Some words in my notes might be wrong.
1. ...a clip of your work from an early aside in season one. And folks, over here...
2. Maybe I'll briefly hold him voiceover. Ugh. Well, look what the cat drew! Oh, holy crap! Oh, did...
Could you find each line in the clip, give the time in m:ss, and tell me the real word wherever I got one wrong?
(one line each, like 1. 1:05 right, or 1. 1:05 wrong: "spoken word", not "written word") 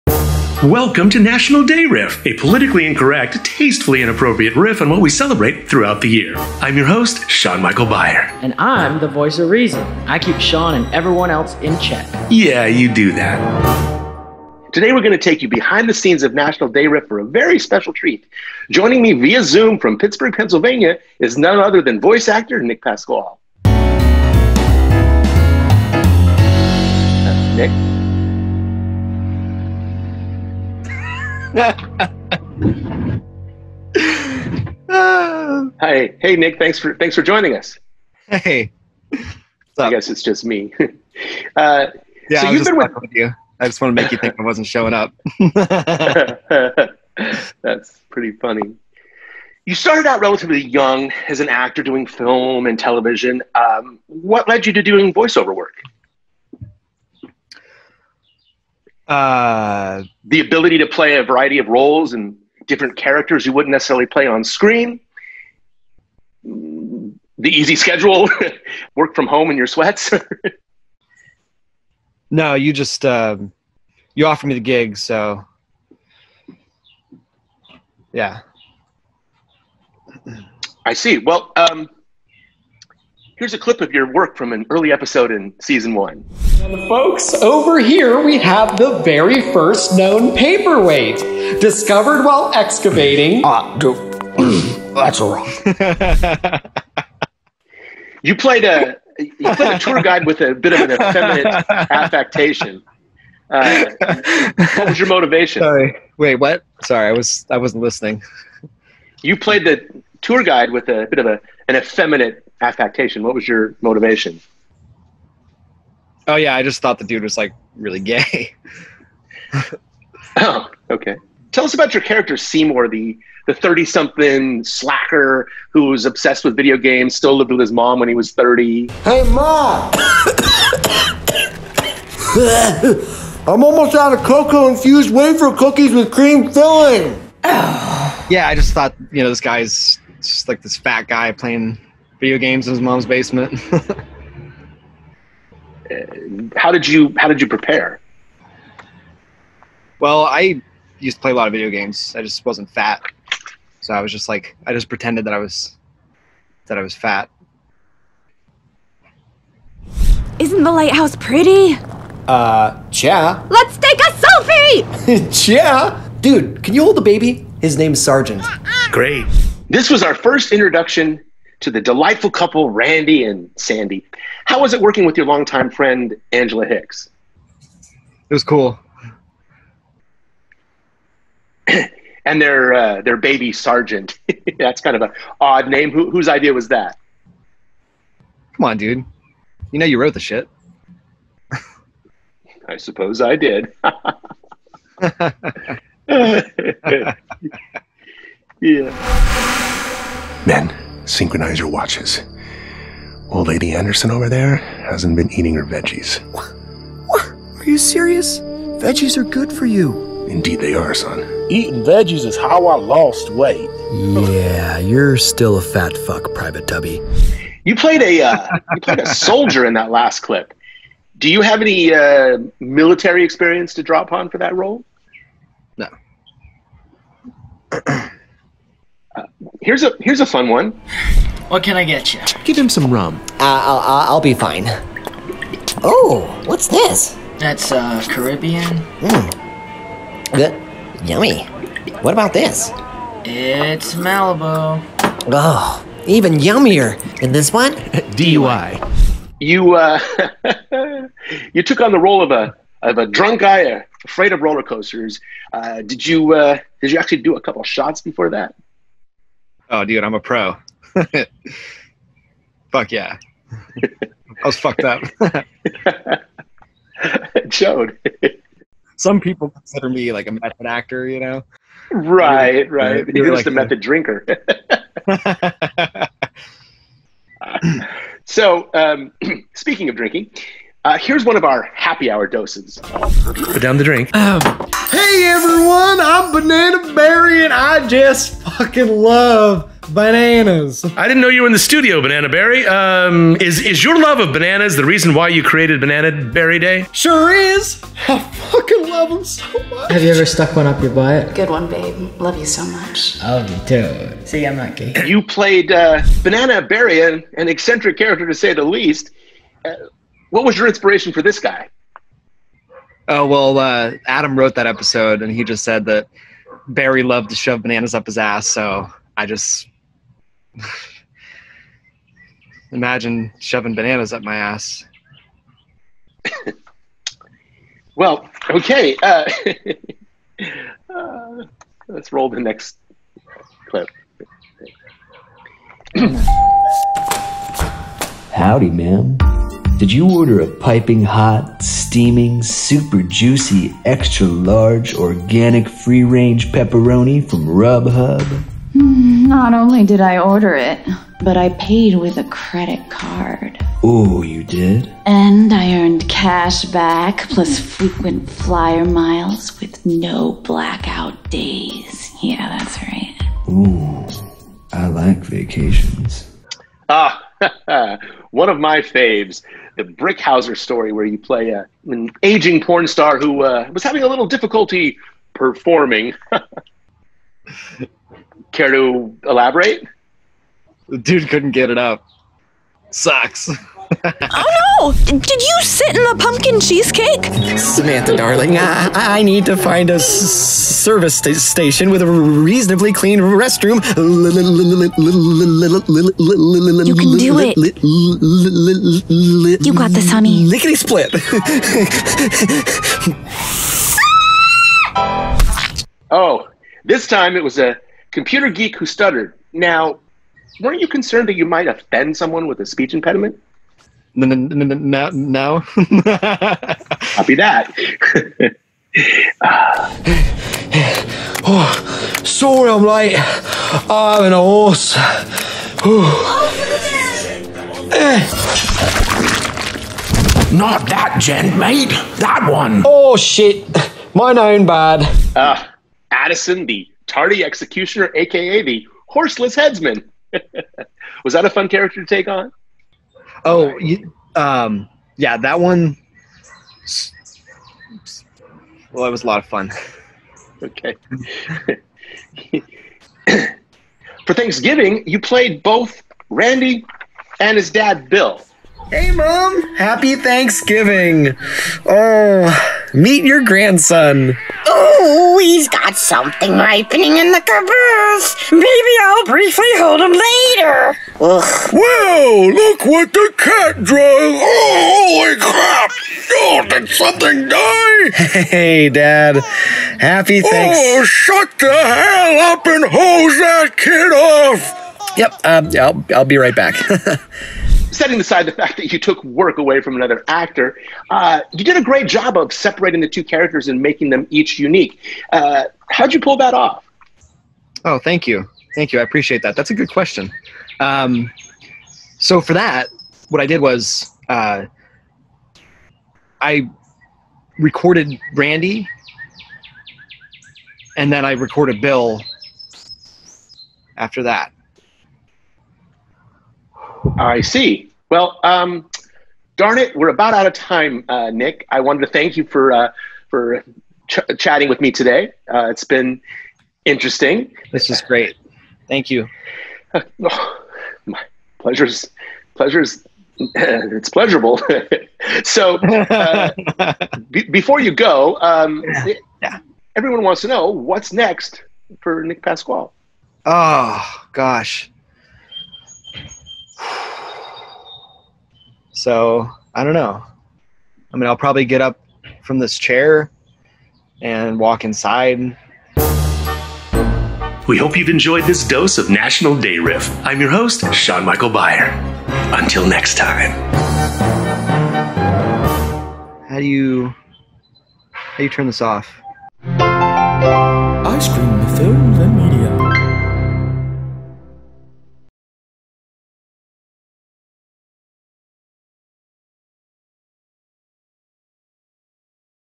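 1. 1:23 wrong: "episode", not "aside"
2. 7:48 wrong: "later", not "voiceover".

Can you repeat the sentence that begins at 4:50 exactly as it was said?
I didn't know you were in the studio, Banana Berry.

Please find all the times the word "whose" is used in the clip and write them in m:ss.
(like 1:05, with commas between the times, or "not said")
3:06.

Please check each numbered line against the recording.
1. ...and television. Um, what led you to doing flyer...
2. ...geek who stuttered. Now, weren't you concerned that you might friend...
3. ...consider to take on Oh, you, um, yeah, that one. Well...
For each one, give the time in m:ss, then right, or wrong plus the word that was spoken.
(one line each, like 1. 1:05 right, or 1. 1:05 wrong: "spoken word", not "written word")
1. 0:52 wrong: "voiceover", not "flyer"
2. 6:48 wrong: "offend", not "friend"
3. 7:21 wrong: "character", not "consider".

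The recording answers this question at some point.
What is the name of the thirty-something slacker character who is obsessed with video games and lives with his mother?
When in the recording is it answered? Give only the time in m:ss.
2:02.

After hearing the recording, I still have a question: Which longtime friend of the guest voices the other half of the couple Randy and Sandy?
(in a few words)
Angela Hicks.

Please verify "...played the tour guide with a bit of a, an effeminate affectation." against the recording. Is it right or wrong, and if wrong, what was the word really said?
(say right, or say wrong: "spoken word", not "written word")
right.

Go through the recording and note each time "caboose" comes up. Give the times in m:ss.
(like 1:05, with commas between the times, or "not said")
7:47.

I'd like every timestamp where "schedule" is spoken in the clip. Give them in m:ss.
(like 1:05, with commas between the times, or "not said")
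1:07.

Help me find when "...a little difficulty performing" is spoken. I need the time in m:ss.
6:14.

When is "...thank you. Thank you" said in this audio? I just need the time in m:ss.
8:17.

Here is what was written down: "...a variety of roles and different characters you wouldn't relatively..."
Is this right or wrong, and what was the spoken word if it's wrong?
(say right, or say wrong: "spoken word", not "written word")
wrong: "necessarily", not "relatively".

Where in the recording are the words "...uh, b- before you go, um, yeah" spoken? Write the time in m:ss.
8:55.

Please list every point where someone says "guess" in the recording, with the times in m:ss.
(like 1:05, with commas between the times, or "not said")
0:39.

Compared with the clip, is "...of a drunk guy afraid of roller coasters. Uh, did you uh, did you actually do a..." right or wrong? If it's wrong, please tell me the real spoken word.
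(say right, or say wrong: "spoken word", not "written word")
right.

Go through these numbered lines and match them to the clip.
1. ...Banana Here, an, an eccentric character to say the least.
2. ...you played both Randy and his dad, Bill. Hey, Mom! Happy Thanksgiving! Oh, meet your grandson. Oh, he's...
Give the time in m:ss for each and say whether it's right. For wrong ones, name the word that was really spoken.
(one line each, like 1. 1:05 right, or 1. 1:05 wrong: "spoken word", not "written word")
1. 5:06 wrong: "Berry", not "Here"
2. 7:35 right.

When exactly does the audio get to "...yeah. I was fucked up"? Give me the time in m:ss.
4:22.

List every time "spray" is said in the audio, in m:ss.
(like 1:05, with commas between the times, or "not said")
not said.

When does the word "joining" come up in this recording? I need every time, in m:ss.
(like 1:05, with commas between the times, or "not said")
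0:18, 0:37.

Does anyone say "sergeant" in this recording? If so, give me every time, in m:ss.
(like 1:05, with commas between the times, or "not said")
2:47, 3:03.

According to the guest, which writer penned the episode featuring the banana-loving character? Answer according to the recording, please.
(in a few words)
Adam.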